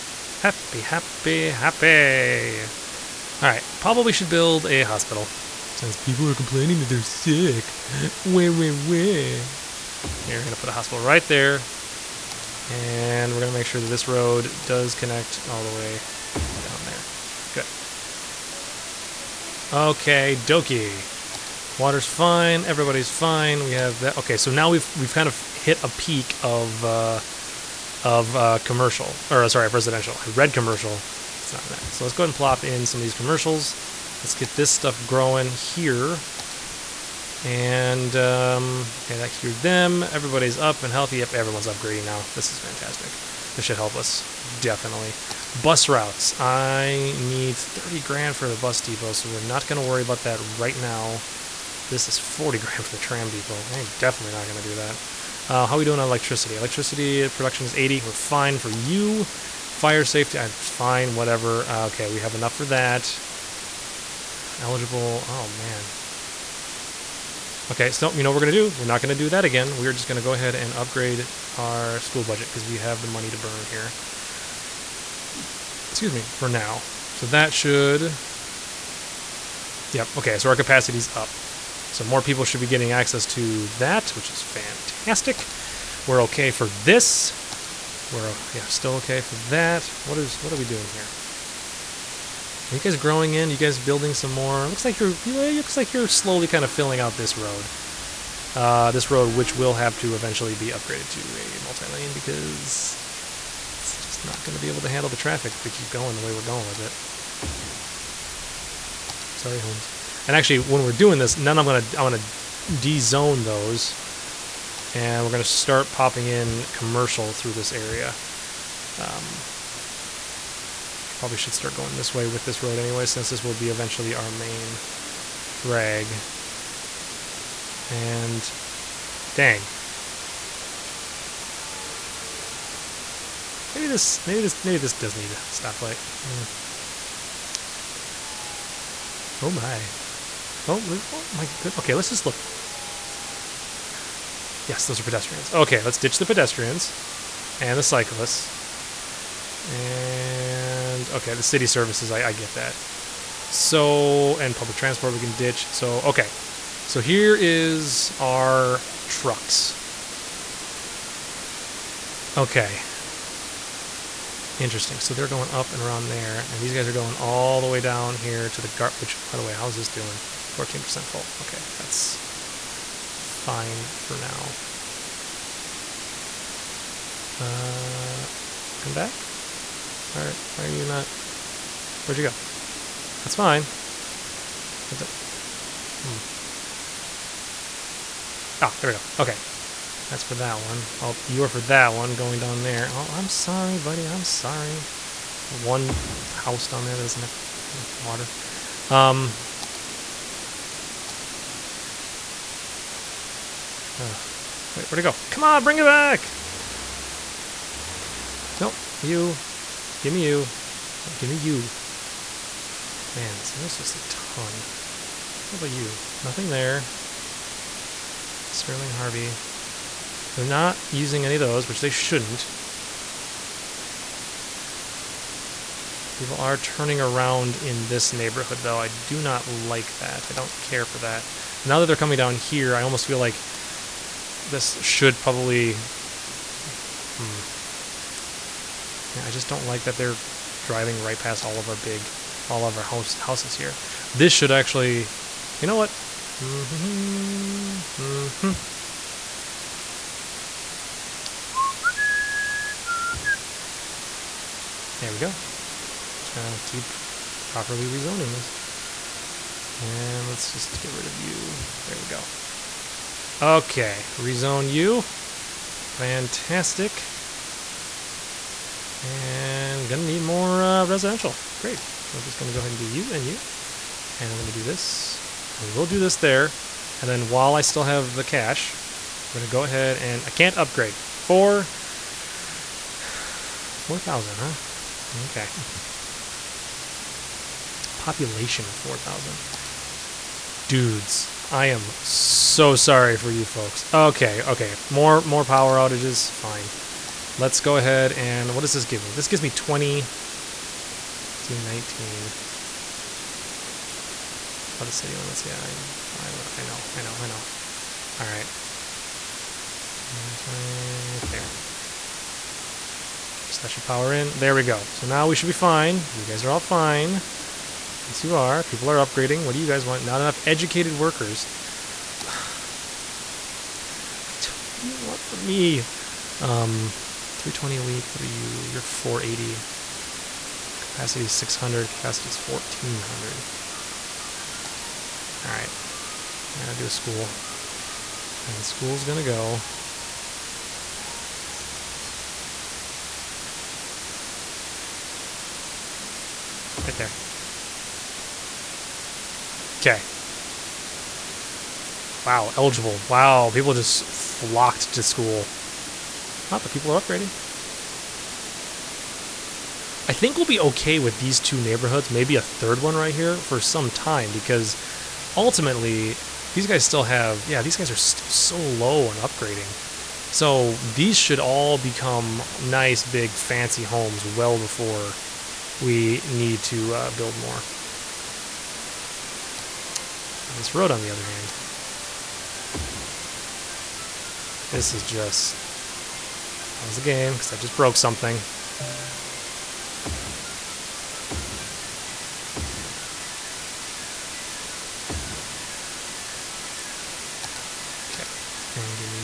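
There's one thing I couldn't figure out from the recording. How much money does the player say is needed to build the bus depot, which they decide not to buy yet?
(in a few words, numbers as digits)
30 grand.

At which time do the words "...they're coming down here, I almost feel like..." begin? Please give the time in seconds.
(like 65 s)
231 s.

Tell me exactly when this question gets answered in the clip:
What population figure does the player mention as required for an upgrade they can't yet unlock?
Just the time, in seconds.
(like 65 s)
287 s.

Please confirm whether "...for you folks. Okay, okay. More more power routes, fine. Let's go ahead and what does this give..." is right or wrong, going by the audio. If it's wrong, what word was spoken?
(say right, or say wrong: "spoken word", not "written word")
wrong: "outages", not "routes".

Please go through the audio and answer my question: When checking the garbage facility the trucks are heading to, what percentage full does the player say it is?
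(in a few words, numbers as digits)
14%.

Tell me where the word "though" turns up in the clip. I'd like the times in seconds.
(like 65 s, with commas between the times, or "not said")
228 s.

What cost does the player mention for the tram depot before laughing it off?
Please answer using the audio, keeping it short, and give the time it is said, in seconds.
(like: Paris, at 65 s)
40 grand, at 52 s.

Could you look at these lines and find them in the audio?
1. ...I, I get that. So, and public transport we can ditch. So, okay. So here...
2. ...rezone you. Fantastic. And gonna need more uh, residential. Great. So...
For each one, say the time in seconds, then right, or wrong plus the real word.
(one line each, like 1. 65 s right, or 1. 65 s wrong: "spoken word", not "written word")
1. 152 s right
2. 264 s right.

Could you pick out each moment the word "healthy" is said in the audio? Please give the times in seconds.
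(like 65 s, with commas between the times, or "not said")
40 s.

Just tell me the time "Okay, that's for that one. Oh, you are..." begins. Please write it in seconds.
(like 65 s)
189 s.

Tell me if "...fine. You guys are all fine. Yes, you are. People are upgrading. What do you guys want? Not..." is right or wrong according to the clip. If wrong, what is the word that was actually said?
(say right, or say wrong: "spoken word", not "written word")
right.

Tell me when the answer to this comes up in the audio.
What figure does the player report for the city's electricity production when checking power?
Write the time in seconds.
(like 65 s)
57 s.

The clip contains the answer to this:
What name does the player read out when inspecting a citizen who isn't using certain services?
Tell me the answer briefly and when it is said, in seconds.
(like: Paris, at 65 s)
Sterling Harvey, at 218 s.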